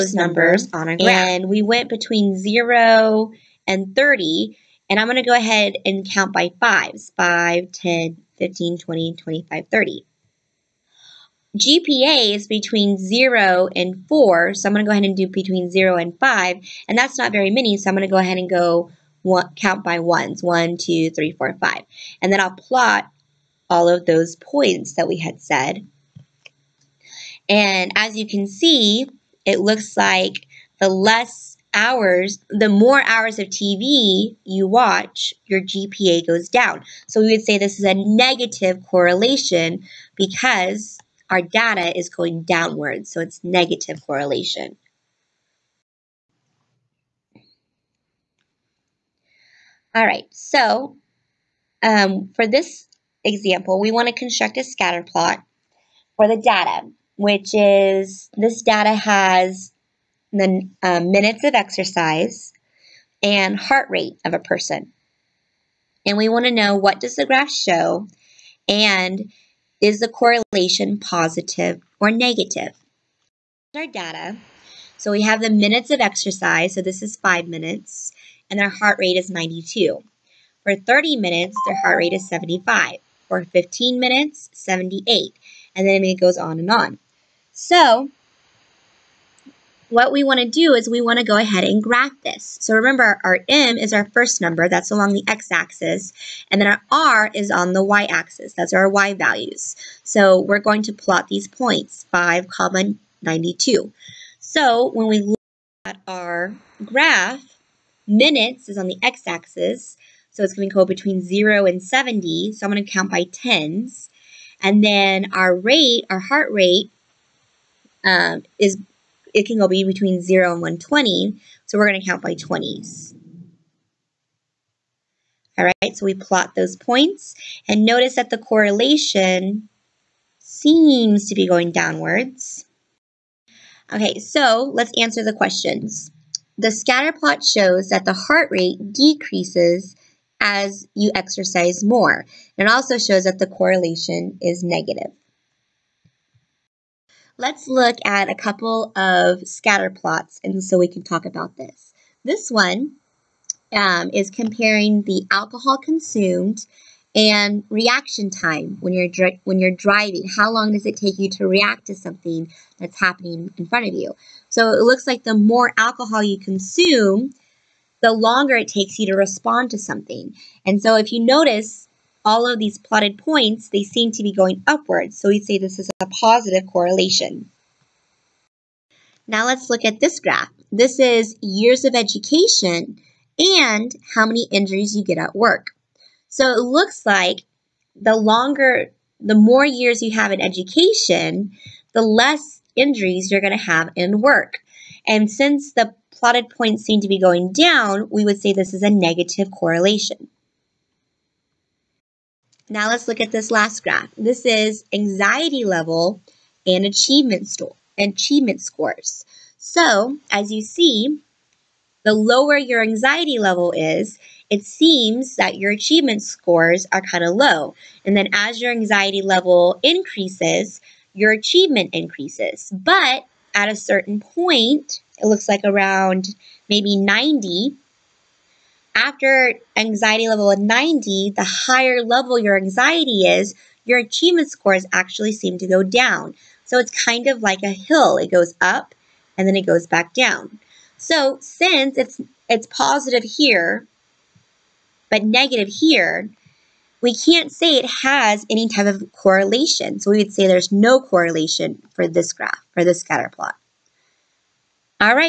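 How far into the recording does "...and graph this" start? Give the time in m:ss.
1:31.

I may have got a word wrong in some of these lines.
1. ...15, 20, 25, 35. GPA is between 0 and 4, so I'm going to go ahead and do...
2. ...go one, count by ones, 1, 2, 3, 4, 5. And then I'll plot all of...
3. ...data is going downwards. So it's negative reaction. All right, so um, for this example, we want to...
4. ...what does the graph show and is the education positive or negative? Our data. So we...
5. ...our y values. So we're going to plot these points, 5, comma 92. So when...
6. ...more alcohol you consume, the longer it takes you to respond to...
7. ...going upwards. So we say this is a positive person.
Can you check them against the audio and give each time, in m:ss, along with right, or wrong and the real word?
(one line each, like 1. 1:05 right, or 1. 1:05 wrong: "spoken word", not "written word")
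1. 0:08 wrong: "30", not "35"
2. 0:18 right
3. 0:41 wrong: "correlation", not "reaction"
4. 1:06 wrong: "correlation", not "education"
5. 1:38 right
6. 2:45 right
7. 2:54 wrong: "correlation", not "person".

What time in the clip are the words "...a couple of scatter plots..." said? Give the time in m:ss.
2:28.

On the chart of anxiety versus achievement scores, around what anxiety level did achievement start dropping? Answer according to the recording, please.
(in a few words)
90.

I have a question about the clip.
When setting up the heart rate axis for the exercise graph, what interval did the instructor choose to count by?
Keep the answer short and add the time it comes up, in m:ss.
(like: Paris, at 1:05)
20s, at 2:02.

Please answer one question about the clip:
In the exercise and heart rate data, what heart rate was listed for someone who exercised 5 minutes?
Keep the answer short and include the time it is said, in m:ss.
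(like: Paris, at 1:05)
92, at 1:18.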